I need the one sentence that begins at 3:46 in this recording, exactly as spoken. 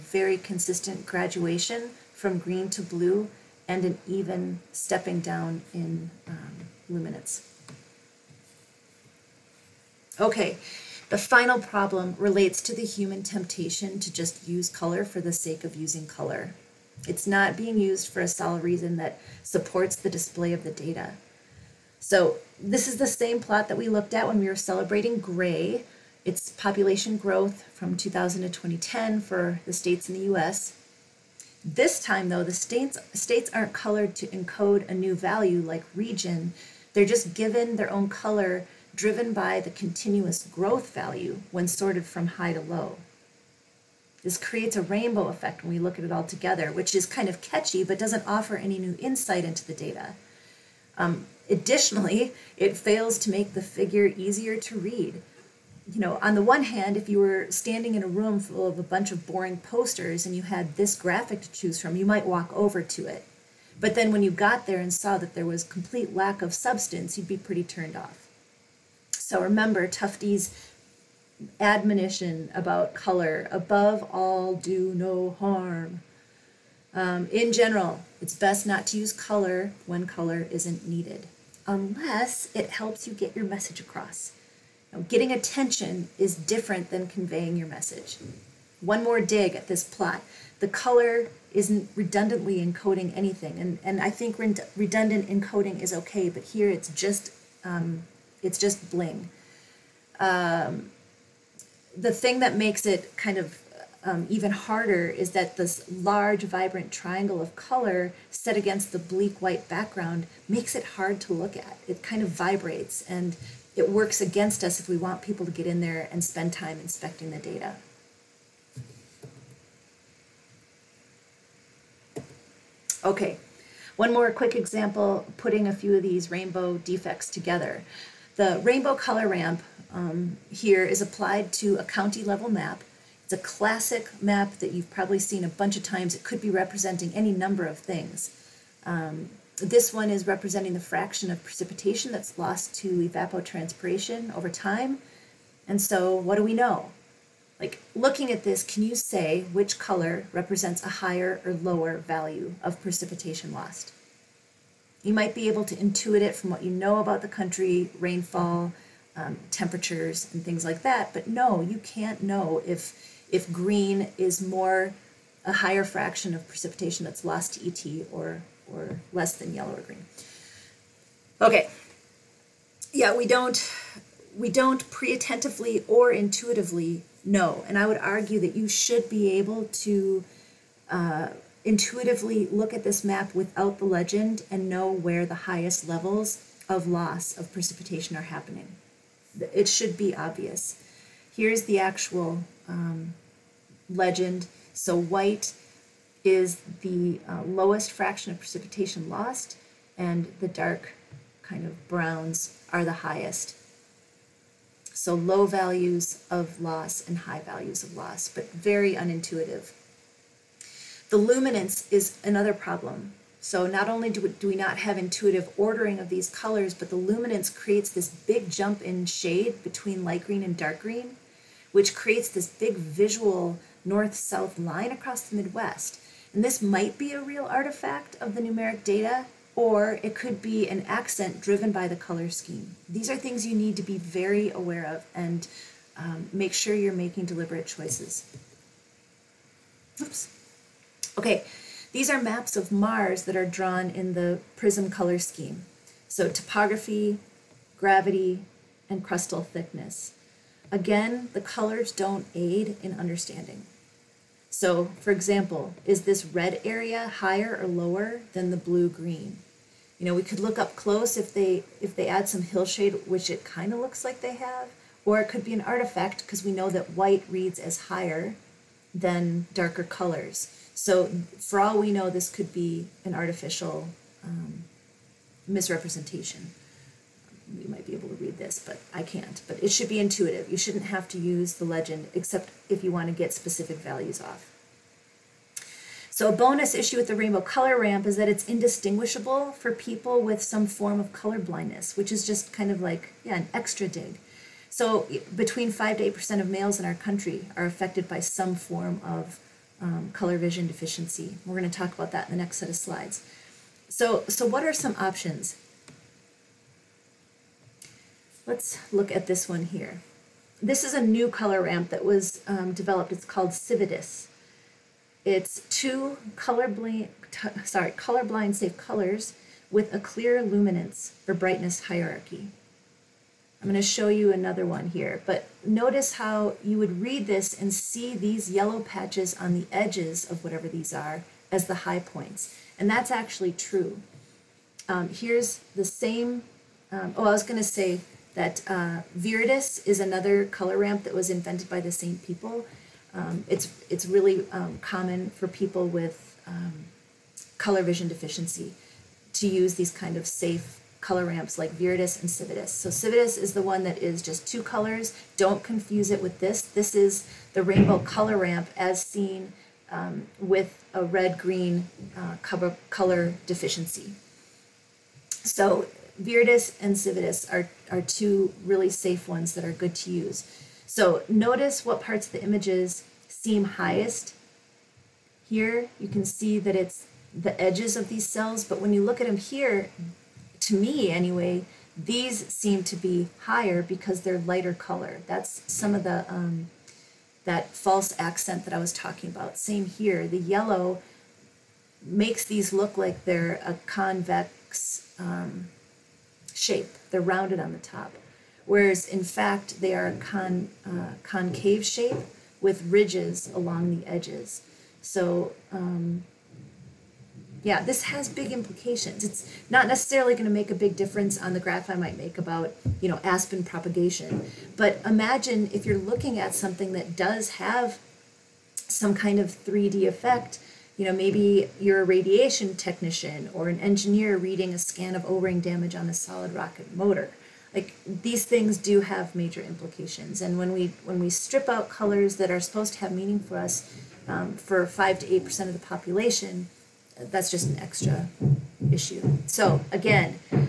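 And this might be a real artifact of the numeric data, or it could be an accent driven by the color scheme.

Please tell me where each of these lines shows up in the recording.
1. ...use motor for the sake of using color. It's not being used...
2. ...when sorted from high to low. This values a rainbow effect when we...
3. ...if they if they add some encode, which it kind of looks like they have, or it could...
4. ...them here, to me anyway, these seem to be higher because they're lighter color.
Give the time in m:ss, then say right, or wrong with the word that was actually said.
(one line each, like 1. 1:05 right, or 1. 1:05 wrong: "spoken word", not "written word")
1. 0:14 wrong: "color", not "motor"
2. 0:41 wrong: "creates", not "values"
3. 4:21 wrong: "hillshade", not "encode"
4. 6:19 right.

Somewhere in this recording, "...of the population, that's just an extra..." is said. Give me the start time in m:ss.
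7:15.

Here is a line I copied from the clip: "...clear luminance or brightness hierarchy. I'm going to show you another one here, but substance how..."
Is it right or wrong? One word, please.
wrong.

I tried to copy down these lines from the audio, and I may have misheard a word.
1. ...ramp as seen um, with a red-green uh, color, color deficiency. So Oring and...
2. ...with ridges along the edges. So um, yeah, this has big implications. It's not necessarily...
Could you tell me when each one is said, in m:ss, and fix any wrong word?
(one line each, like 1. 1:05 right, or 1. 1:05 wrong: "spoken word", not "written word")
1. 5:58 wrong: "Viridis", not "Oring"
2. 6:42 right.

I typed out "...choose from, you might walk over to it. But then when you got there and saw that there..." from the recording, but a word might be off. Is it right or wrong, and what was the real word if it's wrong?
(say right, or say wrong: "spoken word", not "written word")
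right.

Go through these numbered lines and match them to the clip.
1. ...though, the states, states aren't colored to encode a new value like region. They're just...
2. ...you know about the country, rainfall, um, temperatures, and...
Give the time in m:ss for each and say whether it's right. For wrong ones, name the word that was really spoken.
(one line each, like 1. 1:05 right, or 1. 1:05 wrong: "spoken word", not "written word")
1. 0:32 right
2. 2:36 right.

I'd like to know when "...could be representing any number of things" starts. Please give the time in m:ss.
2:16.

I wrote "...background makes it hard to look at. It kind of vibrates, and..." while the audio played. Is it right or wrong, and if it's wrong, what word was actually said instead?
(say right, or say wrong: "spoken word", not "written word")
right.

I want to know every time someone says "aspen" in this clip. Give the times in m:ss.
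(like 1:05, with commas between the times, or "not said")
6:53.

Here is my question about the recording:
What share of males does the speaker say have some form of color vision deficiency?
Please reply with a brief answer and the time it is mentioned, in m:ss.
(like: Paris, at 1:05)
5 to 8%, at 4:55.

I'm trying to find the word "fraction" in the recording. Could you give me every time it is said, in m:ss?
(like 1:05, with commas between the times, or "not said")
2:20, 2:45, 3:17.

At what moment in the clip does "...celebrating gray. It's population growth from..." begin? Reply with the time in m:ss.
0:24.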